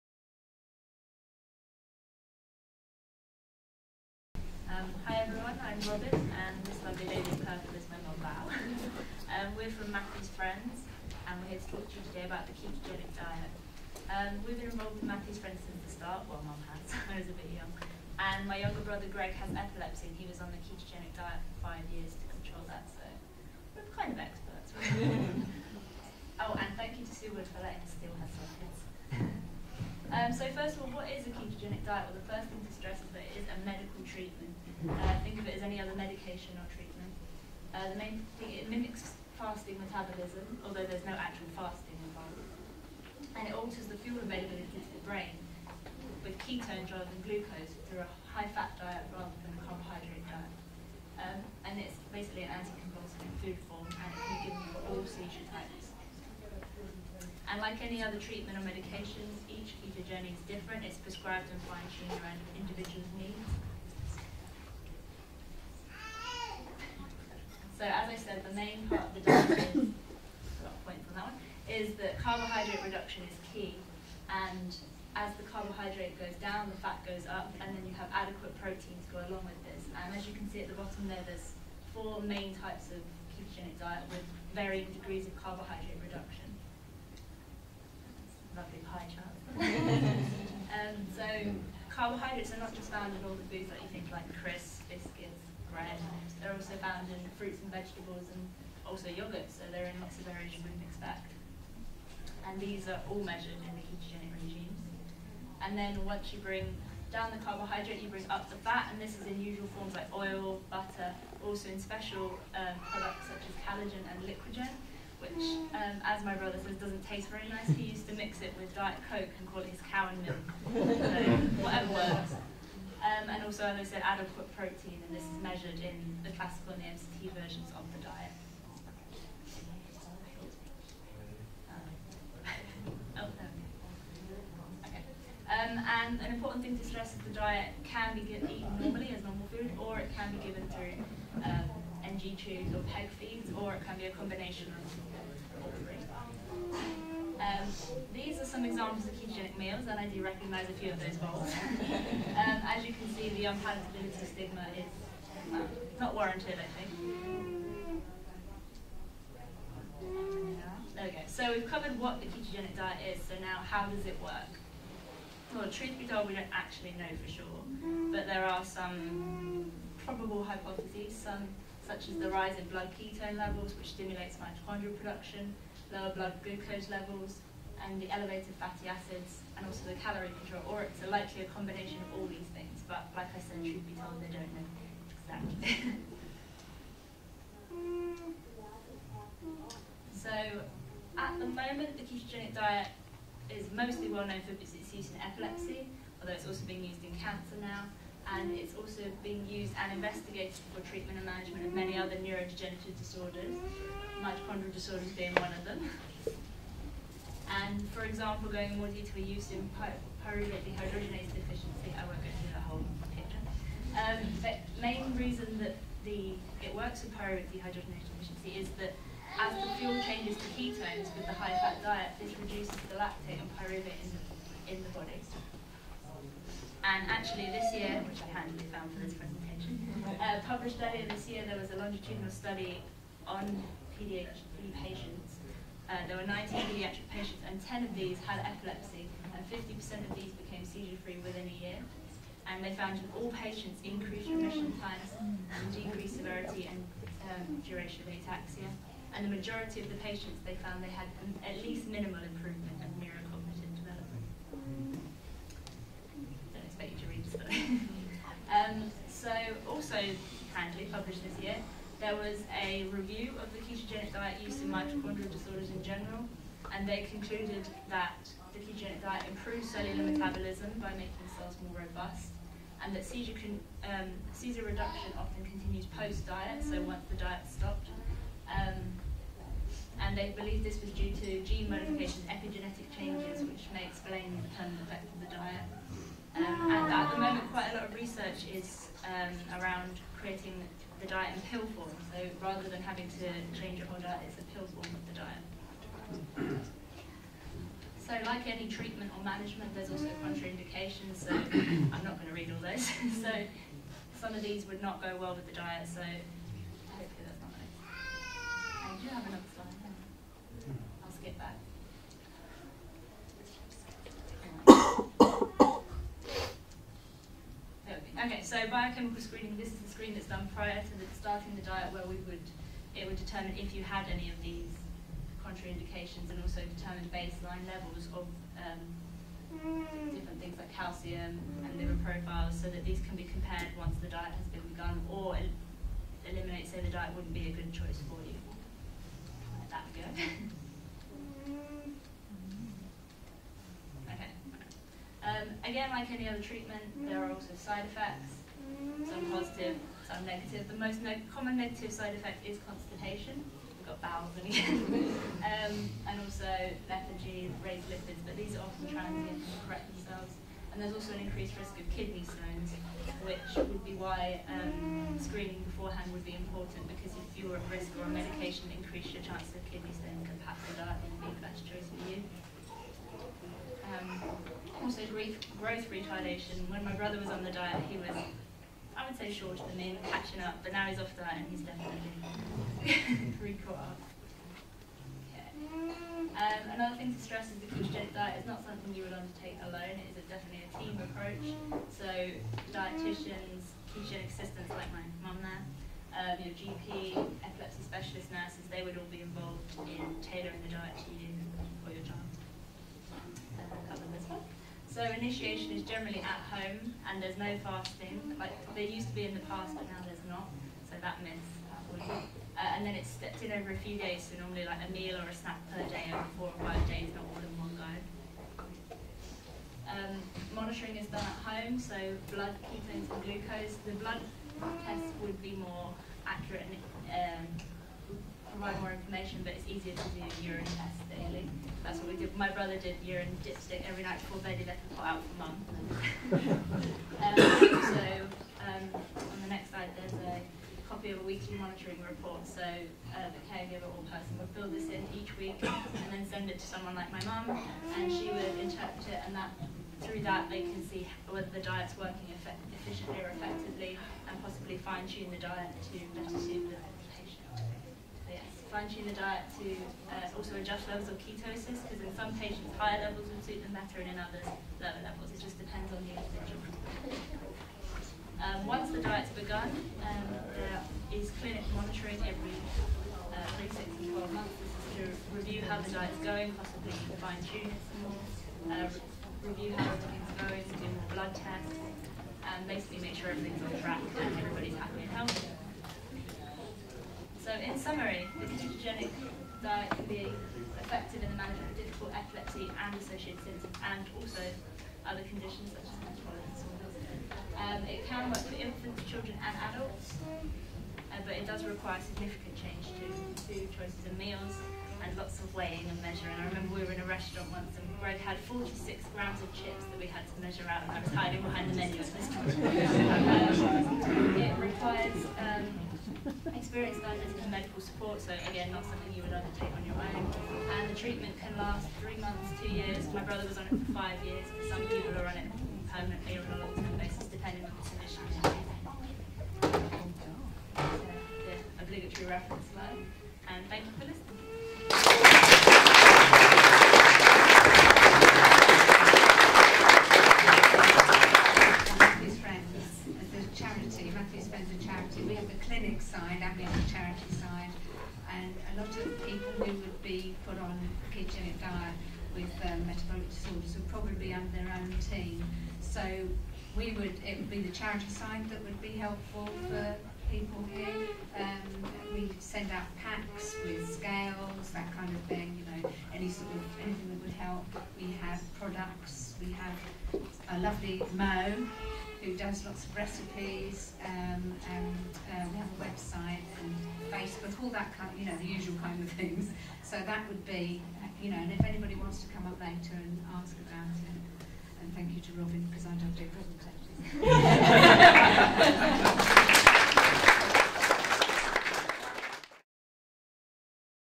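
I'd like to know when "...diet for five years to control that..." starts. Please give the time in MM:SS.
00:21.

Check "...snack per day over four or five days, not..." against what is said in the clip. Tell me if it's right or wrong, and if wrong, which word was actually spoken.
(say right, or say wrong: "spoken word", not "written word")
right.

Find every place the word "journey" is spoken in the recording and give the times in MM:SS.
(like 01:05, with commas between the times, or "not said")
01:00.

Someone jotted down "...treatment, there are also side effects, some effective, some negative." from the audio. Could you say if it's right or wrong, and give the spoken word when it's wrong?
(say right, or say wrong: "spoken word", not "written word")
wrong: "positive", not "effective".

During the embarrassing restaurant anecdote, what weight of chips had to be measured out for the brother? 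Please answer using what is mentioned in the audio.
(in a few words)
46 grams.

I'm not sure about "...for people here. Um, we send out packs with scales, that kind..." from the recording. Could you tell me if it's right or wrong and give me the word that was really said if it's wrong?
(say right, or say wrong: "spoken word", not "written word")
right.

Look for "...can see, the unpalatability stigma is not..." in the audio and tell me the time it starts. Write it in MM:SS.
02:32.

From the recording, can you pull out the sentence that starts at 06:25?
Um, another thing to stress is the ketogenic diet is not something you would undertake alone.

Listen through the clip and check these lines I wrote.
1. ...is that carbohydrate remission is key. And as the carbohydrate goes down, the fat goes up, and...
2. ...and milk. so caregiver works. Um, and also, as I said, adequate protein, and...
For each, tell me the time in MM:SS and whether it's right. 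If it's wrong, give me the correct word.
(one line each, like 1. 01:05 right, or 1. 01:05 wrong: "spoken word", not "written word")
1. 01:11 wrong: "reduction", not "remission"
2. 02:00 wrong: "whatever", not "caregiver".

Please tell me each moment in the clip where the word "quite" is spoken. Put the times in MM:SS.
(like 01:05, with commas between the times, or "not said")
04:47.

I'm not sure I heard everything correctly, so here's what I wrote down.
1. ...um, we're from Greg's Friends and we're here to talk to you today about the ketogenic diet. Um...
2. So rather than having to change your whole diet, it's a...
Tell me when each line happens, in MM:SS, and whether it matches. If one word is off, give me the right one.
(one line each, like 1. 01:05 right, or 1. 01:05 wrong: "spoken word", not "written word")
1. 00:09 wrong: "Matthew", not "Greg"
2. 04:52 right.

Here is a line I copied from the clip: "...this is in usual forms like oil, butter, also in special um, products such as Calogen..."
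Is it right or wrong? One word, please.
right.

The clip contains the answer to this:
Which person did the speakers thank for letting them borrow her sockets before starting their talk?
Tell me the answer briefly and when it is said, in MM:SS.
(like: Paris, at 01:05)
Sue Wood, at 00:27.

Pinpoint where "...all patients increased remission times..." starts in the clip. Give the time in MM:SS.
04:03.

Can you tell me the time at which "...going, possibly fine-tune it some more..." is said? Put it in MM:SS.
07:56.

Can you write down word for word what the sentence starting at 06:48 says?
Like there used to be in the past, but now there's not.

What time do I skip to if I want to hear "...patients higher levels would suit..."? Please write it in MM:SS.
07:42.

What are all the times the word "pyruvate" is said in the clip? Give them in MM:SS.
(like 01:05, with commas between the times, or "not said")
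03:30, 03:37, 03:43.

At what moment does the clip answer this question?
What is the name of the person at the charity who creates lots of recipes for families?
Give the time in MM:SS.
09:31.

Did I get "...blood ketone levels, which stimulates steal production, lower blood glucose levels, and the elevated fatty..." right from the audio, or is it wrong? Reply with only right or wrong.
wrong.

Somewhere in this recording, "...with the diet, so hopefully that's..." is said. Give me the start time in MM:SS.
05:05.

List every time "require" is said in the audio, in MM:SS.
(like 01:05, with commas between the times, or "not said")
08:21, 08:34.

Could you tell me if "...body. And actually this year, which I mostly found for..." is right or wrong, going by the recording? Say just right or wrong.
wrong.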